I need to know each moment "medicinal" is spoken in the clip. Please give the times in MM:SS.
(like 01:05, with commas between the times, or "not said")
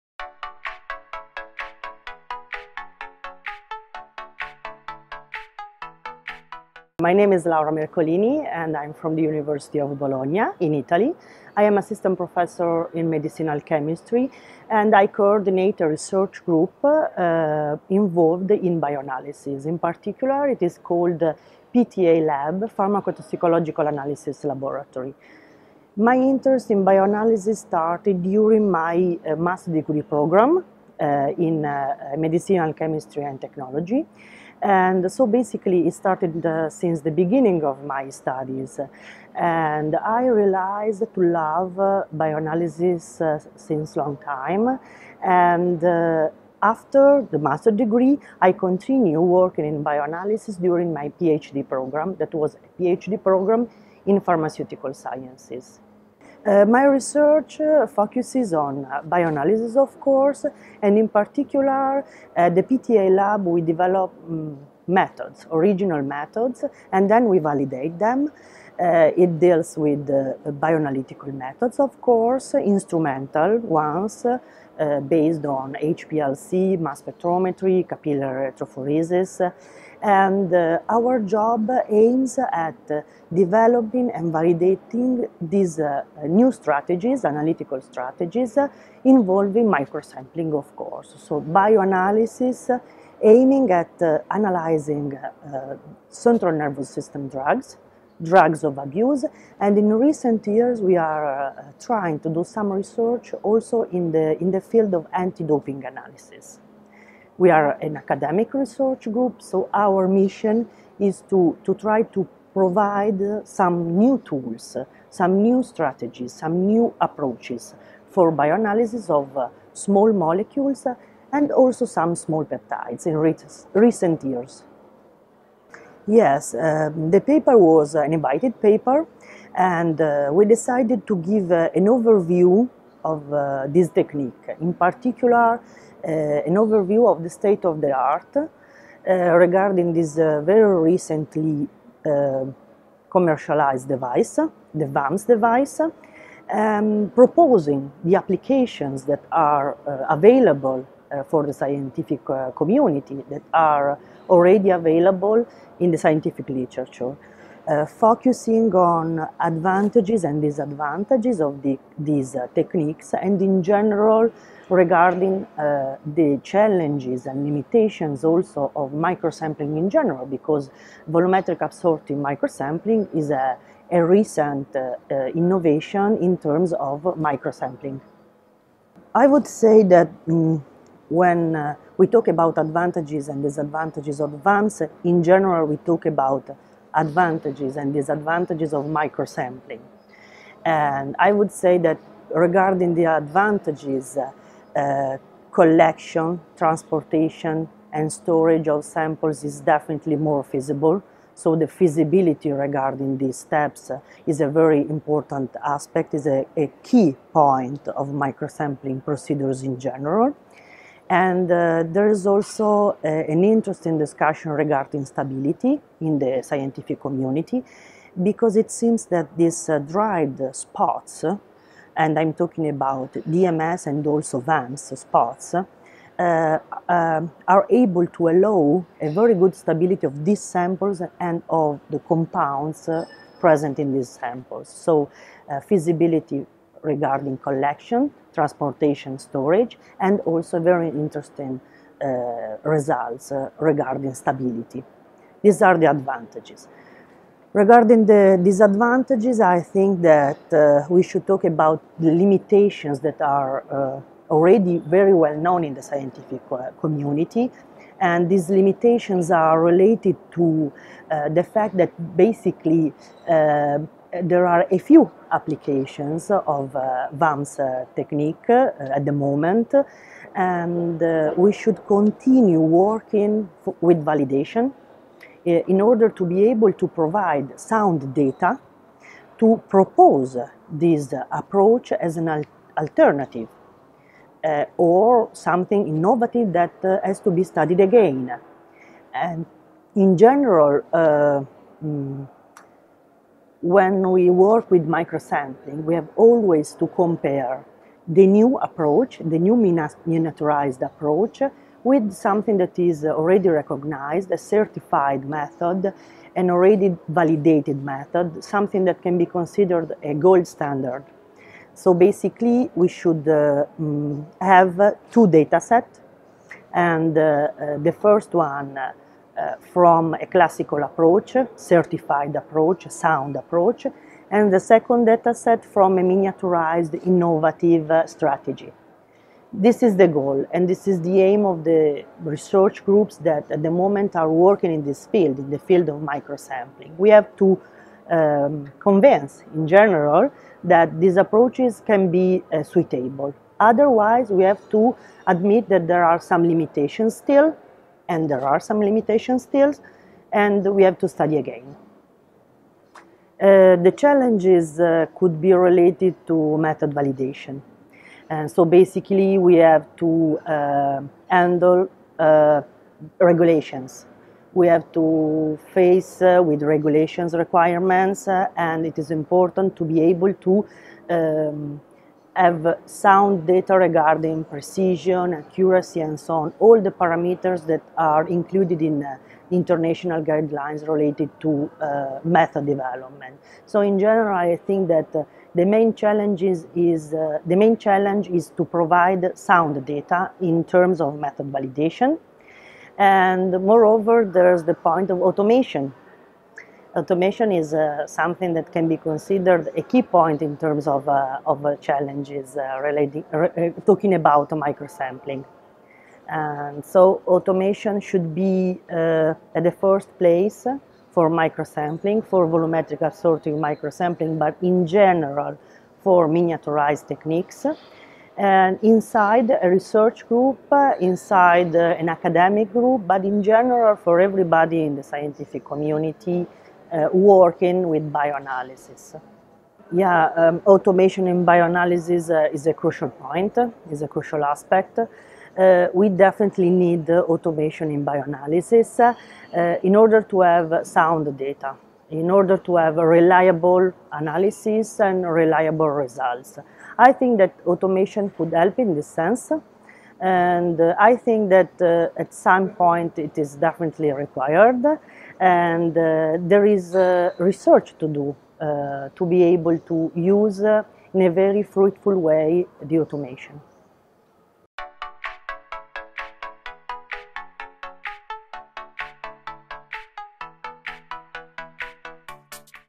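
00:13, 00:32.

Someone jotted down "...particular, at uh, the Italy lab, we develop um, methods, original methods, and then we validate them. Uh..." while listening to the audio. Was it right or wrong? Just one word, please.
wrong.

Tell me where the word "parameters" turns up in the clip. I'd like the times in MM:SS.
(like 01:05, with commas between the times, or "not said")
06:16.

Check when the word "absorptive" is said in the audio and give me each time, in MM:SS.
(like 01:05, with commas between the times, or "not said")
02:51, 06:53.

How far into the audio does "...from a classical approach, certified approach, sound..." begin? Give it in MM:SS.
05:19.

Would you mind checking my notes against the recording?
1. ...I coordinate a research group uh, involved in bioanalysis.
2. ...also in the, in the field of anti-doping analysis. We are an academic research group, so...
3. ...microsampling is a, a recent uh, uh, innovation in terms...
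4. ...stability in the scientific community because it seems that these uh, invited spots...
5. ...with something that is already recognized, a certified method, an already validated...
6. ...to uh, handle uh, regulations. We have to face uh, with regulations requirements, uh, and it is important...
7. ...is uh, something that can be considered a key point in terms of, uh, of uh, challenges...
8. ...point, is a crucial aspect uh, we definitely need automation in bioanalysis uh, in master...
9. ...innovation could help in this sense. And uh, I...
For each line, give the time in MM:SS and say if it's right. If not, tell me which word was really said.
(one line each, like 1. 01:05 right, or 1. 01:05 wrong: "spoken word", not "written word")
1. 00:14 right
2. 01:43 right
3. 02:52 right
4. 03:35 wrong: "dried", not "invited"
5. 05:01 right
6. 05:59 right
7. 06:37 right
8. 07:13 wrong: "order", not "master"
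9. 07:27 wrong: "automation", not "innovation".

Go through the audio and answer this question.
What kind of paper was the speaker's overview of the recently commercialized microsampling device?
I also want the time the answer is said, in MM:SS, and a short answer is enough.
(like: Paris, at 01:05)
An invited paper, at 02:08.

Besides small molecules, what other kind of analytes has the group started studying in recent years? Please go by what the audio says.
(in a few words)
Small peptides.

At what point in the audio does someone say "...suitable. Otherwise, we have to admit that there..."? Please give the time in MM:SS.
05:42.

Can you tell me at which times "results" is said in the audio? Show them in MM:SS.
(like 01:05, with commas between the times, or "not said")
04:02, 07:25.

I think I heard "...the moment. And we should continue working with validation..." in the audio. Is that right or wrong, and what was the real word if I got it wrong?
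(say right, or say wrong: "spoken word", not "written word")
right.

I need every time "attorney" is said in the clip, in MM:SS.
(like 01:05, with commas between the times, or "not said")
not said.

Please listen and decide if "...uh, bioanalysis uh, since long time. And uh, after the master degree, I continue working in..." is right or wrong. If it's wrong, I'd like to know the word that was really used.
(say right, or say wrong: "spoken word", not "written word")
right.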